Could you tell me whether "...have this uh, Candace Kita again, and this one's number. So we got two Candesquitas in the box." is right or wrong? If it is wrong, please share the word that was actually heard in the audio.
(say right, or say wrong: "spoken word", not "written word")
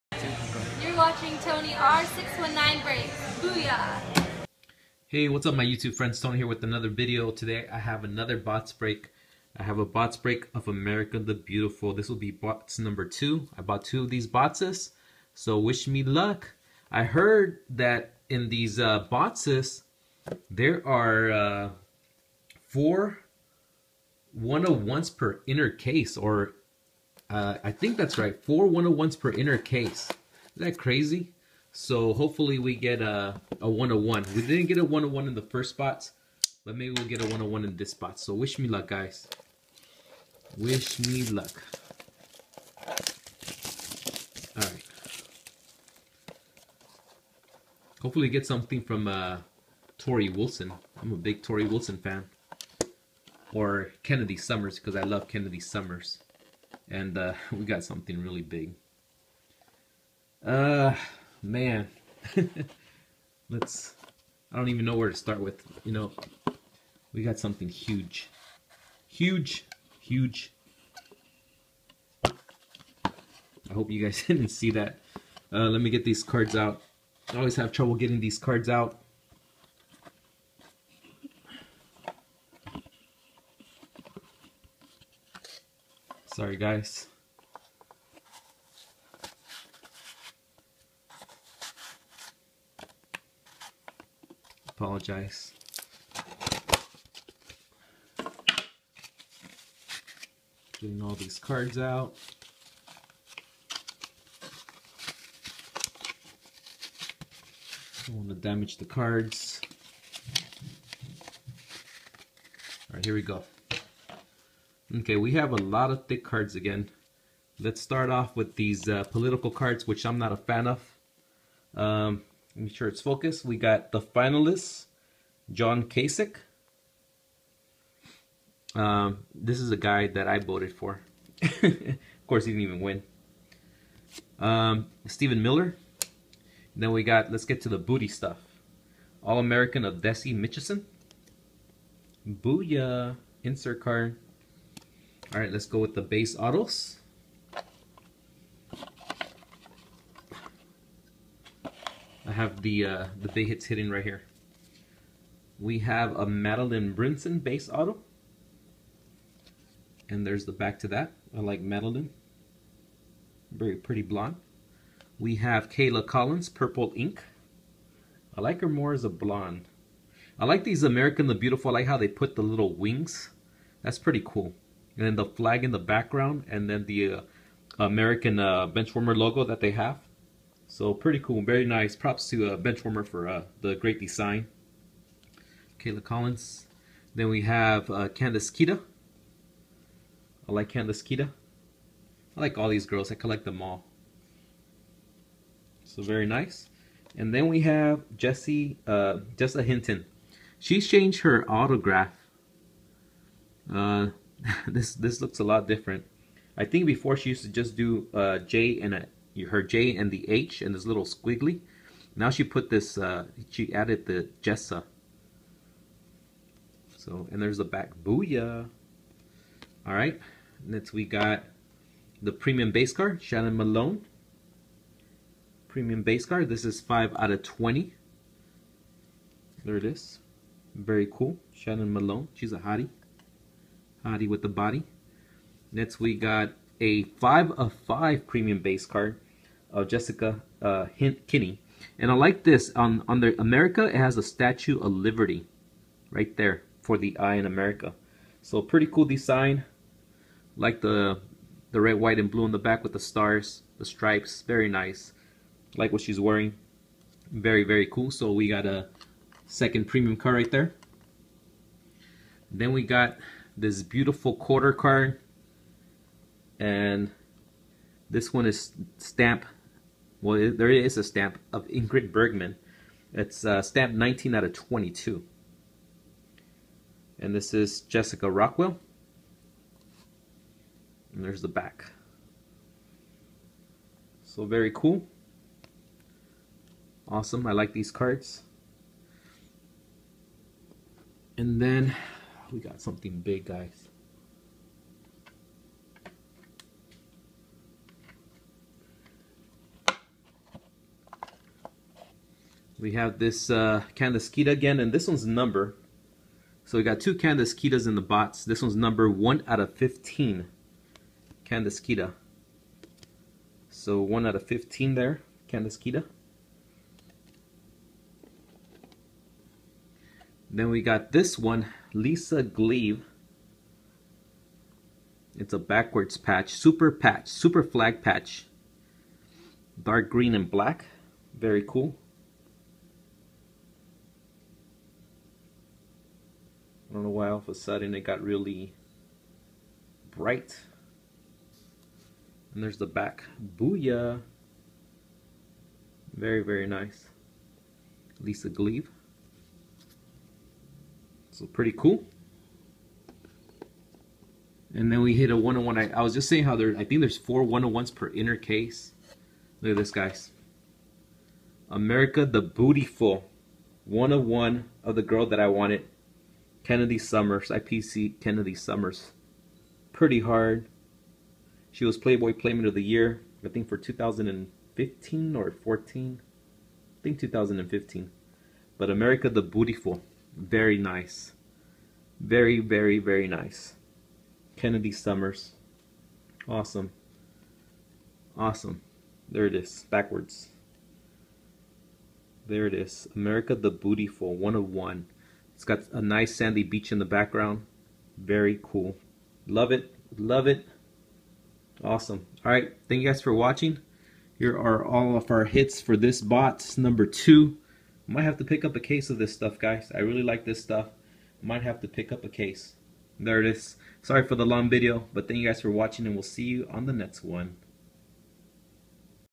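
right.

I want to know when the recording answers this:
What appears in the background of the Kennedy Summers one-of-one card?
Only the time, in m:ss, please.
6:36.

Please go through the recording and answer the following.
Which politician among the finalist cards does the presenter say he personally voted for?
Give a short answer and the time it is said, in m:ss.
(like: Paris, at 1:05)
John Kasich, at 2:05.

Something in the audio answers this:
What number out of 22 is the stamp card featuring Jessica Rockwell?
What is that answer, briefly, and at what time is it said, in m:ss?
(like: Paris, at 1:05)
19, at 4:33.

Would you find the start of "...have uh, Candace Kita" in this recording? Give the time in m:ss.
3:07.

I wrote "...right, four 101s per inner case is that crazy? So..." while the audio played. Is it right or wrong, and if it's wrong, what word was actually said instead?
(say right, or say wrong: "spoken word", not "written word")
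right.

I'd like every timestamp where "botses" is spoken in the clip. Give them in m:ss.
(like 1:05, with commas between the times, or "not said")
0:14, 0:19.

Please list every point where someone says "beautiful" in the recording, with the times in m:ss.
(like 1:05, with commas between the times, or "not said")
0:11, 2:51, 4:23, 6:19, 6:33.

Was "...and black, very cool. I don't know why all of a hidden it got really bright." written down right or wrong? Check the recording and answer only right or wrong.
wrong.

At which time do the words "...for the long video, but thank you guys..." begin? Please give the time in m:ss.
6:54.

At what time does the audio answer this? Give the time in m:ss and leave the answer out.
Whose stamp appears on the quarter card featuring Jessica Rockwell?
4:31.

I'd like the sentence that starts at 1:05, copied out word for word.
You know, we got something huge.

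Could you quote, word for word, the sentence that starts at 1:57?
Let's start off with these uh, political cards, which I'm not a fan of.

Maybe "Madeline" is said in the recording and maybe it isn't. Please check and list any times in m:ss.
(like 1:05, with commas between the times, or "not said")
2:36, 2:41.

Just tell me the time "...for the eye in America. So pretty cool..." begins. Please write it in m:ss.
4:06.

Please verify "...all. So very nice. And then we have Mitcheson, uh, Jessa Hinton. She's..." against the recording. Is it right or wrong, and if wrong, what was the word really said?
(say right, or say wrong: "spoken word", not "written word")
wrong: "Jessie", not "Mitcheson".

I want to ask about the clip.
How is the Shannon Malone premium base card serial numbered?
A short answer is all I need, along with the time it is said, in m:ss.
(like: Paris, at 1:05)
5 out of 20, at 3:46.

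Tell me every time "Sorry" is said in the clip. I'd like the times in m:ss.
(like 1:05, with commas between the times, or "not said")
1:26, 6:54.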